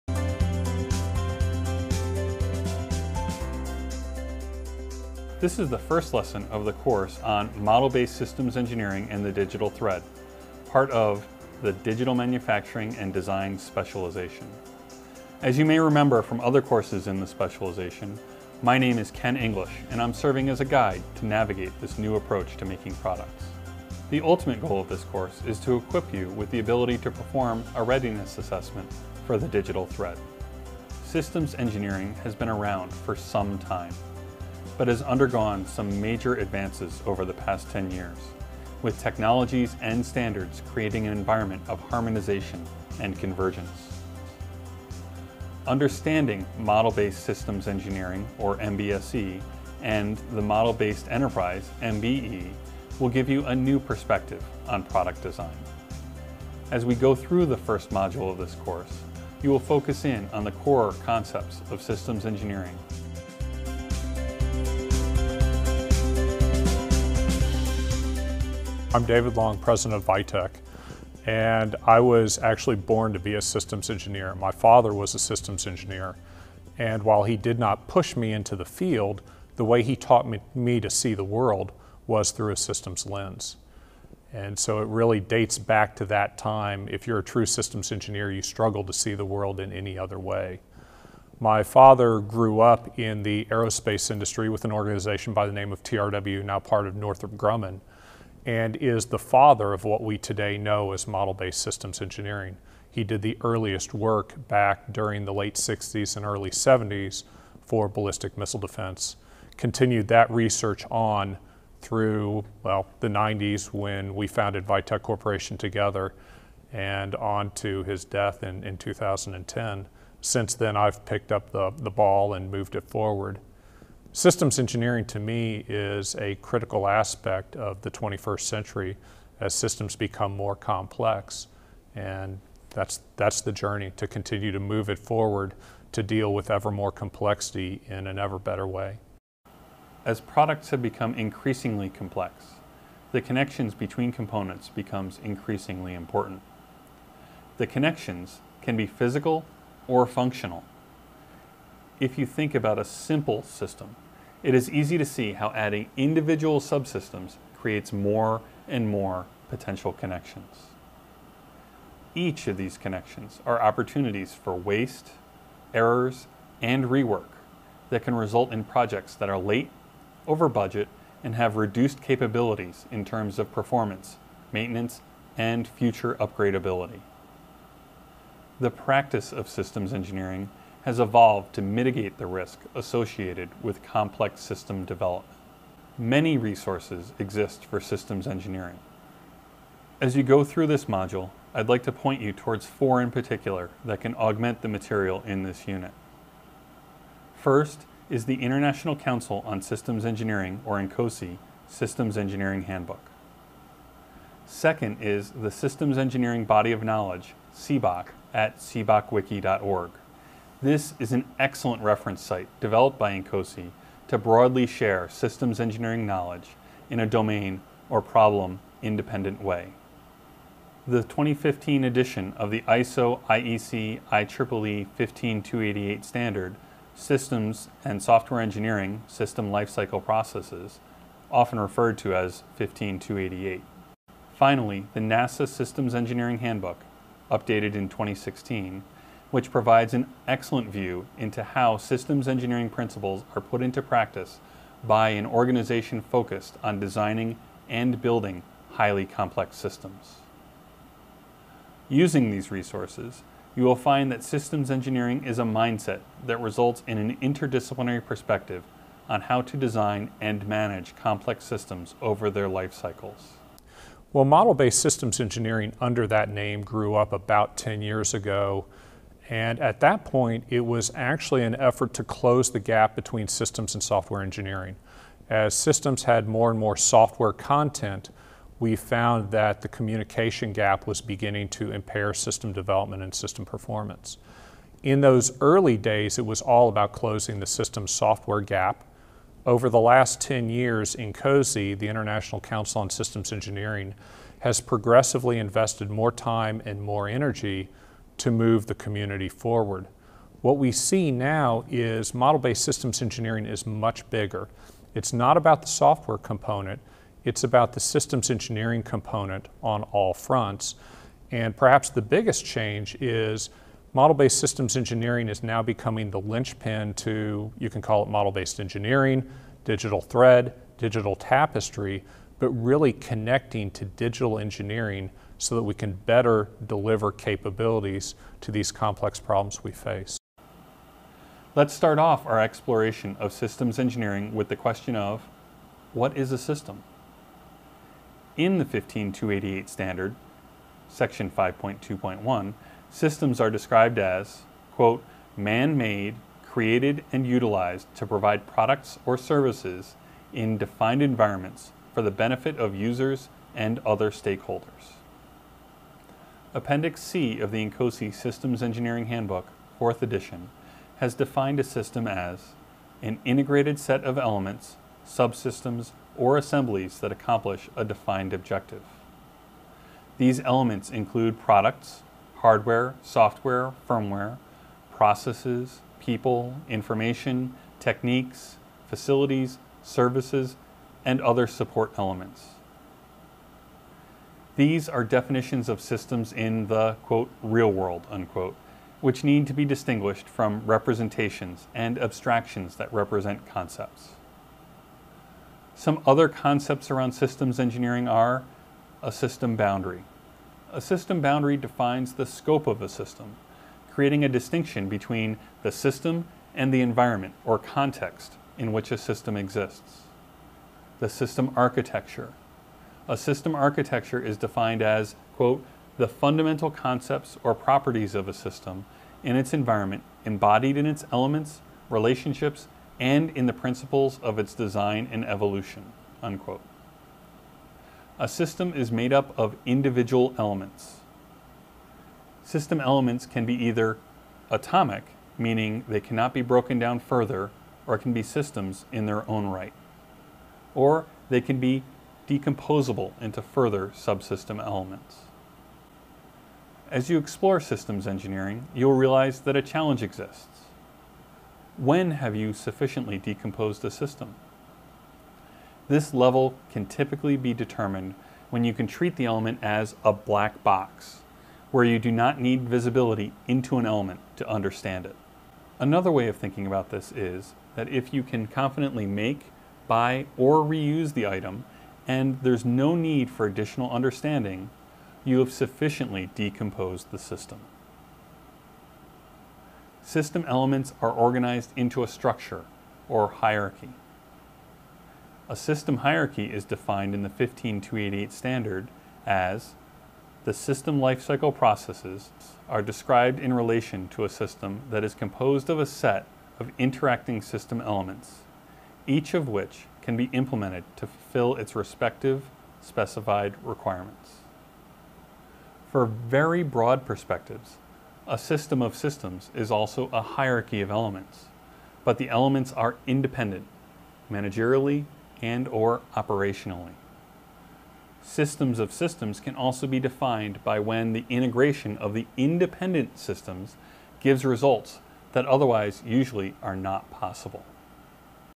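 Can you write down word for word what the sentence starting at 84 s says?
And so it really dates back to that time.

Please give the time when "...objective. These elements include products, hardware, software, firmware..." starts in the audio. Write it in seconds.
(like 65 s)
368 s.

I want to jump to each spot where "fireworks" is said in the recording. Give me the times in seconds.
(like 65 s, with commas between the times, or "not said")
not said.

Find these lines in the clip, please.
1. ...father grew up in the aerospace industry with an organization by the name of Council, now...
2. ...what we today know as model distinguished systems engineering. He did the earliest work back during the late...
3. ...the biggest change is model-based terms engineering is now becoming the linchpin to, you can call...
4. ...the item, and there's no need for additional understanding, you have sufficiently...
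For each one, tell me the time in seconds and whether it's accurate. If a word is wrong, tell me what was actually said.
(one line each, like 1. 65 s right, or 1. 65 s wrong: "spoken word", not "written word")
1. 91 s wrong: "TRW", not "Council"
2. 99 s wrong: "based", not "distinguished"
3. 311 s wrong: "systems", not "terms"
4. 471 s right.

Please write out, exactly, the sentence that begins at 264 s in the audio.
Well, model-based systems engineering under that name grew up about 10 years ago.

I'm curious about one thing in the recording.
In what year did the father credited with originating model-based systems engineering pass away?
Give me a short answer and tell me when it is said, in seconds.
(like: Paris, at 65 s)
2010, at 118 s.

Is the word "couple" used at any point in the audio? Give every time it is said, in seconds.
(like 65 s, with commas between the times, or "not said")
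not said.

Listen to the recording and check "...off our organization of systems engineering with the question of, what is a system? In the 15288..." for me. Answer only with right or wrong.
wrong.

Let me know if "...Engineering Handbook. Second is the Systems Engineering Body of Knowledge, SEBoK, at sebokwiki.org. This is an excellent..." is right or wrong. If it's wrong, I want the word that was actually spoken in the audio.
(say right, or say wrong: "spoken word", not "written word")
right.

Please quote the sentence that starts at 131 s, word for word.
And that's, that's the journey to continue to move it forward to deal with ever more complexity in an ever better way.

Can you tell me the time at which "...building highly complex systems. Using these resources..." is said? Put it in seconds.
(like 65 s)
248 s.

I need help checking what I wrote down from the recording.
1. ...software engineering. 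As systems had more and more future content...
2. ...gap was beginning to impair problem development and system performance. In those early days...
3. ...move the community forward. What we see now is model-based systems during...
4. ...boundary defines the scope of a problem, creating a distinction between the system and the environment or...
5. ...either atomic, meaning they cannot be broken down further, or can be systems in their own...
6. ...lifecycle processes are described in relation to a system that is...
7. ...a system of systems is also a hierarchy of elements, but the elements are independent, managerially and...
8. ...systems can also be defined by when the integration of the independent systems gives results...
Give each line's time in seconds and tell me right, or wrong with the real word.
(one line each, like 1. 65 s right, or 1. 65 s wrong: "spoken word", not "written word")
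1. 273 s wrong: "software", not "future"
2. 280 s wrong: "system", not "problem"
3. 298 s wrong: "engineering", not "during"
4. 401 s wrong: "system", not "problem"
5. 433 s right
6. 490 s right
7. 508 s right
8. 518 s right.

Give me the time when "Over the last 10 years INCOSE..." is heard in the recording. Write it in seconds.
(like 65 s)
289 s.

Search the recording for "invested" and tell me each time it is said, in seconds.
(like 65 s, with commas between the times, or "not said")
295 s.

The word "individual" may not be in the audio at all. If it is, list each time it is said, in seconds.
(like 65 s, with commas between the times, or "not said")
155 s, 429 s.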